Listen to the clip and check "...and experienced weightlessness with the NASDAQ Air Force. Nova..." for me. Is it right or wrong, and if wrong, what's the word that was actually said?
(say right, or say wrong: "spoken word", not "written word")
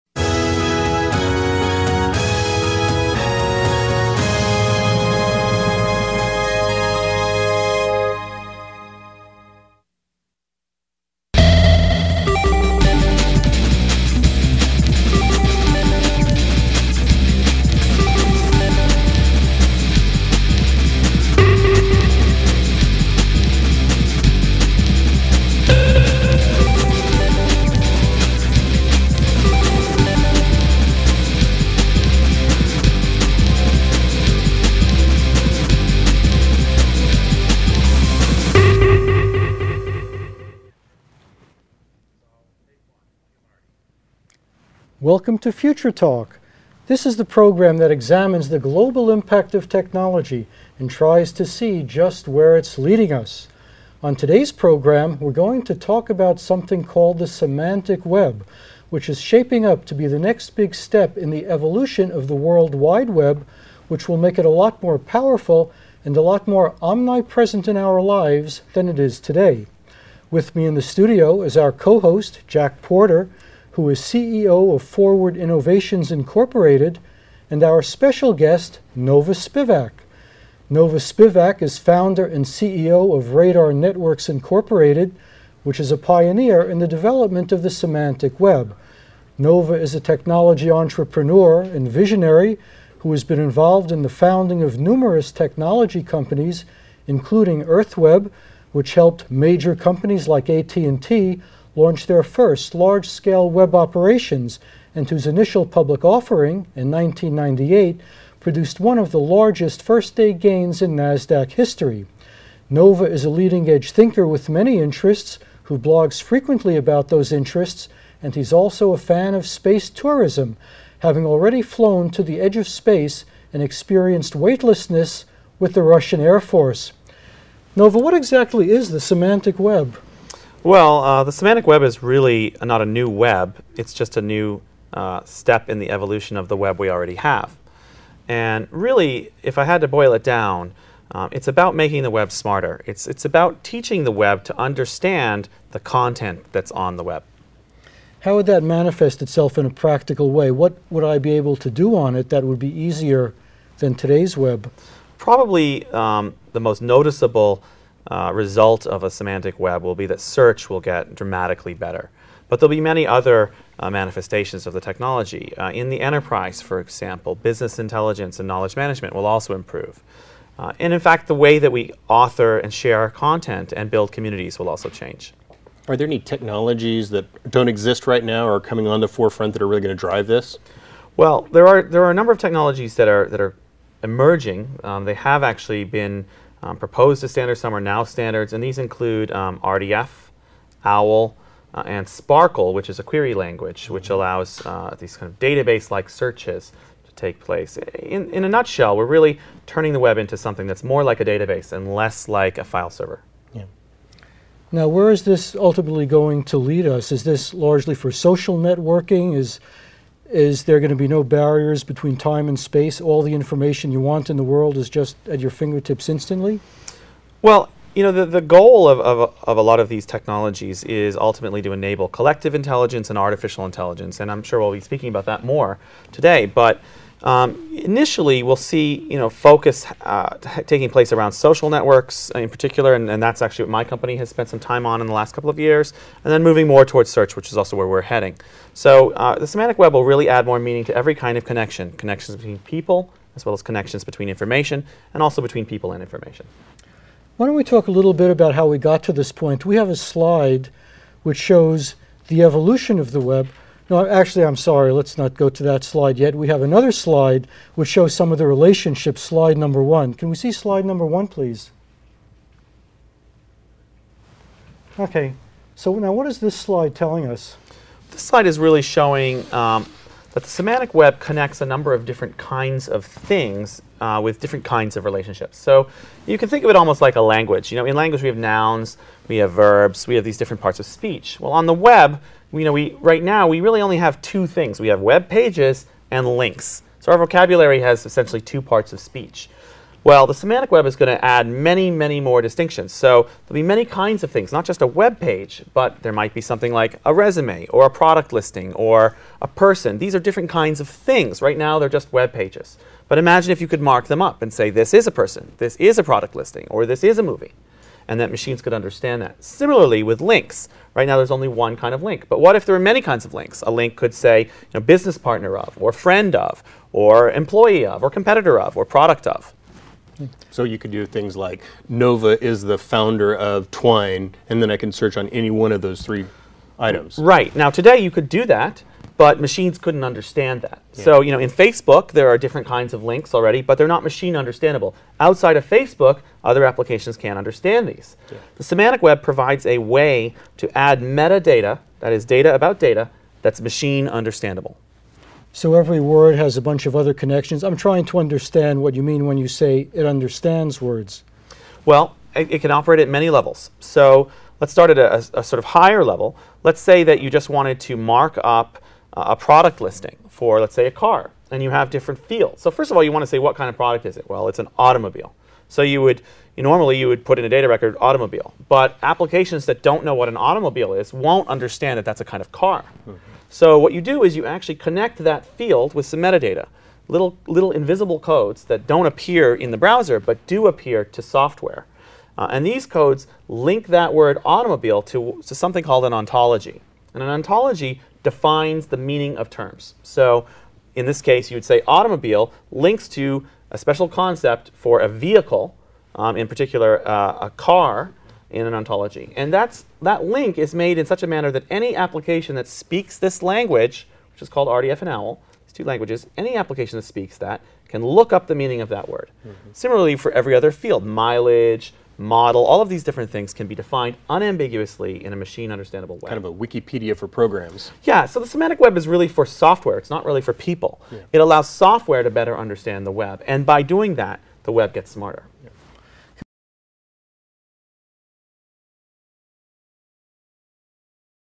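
wrong: "Russian", not "NASDAQ".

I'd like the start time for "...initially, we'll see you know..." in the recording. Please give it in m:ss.
3:47.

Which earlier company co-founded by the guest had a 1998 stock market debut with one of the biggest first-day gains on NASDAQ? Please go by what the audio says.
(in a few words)
EarthWeb.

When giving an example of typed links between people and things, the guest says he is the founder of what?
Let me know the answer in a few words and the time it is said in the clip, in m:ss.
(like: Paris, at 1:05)
Twine, at 5:23.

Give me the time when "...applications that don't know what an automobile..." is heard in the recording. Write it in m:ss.
6:09.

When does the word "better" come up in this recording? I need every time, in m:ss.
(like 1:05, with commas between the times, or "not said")
2:41, 7:02.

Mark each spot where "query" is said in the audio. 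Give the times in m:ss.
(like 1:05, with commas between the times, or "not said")
3:13.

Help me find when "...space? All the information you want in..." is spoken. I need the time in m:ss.
3:32.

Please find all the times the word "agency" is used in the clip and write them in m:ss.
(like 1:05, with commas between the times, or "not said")
not said.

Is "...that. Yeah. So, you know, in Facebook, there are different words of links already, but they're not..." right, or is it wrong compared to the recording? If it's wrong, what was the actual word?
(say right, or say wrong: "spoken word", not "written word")
wrong: "kinds", not "words".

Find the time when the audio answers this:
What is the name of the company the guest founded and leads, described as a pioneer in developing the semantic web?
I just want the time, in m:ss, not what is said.
1:23.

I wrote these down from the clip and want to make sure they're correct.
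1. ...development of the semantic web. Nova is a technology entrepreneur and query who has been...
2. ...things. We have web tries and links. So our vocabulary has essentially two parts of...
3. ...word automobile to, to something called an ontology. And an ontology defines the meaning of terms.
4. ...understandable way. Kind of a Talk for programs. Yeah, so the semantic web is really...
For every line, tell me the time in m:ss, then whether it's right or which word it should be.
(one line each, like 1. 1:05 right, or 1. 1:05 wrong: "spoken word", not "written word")
1. 1:26 wrong: "visionary", not "query"
2. 4:44 wrong: "pages", not "tries"
3. 6:24 right
4. 6:55 wrong: "Wikipedia", not "Talk".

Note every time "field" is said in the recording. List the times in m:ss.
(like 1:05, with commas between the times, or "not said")
6:02, 6:15, 6:50.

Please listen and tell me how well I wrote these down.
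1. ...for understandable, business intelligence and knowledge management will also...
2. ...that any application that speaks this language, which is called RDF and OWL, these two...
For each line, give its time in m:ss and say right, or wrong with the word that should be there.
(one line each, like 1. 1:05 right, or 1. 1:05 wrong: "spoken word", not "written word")
1. 2:46 wrong: "example", not "understandable"
2. 6:41 right.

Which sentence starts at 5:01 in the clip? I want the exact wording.
Right now, they're just web pages.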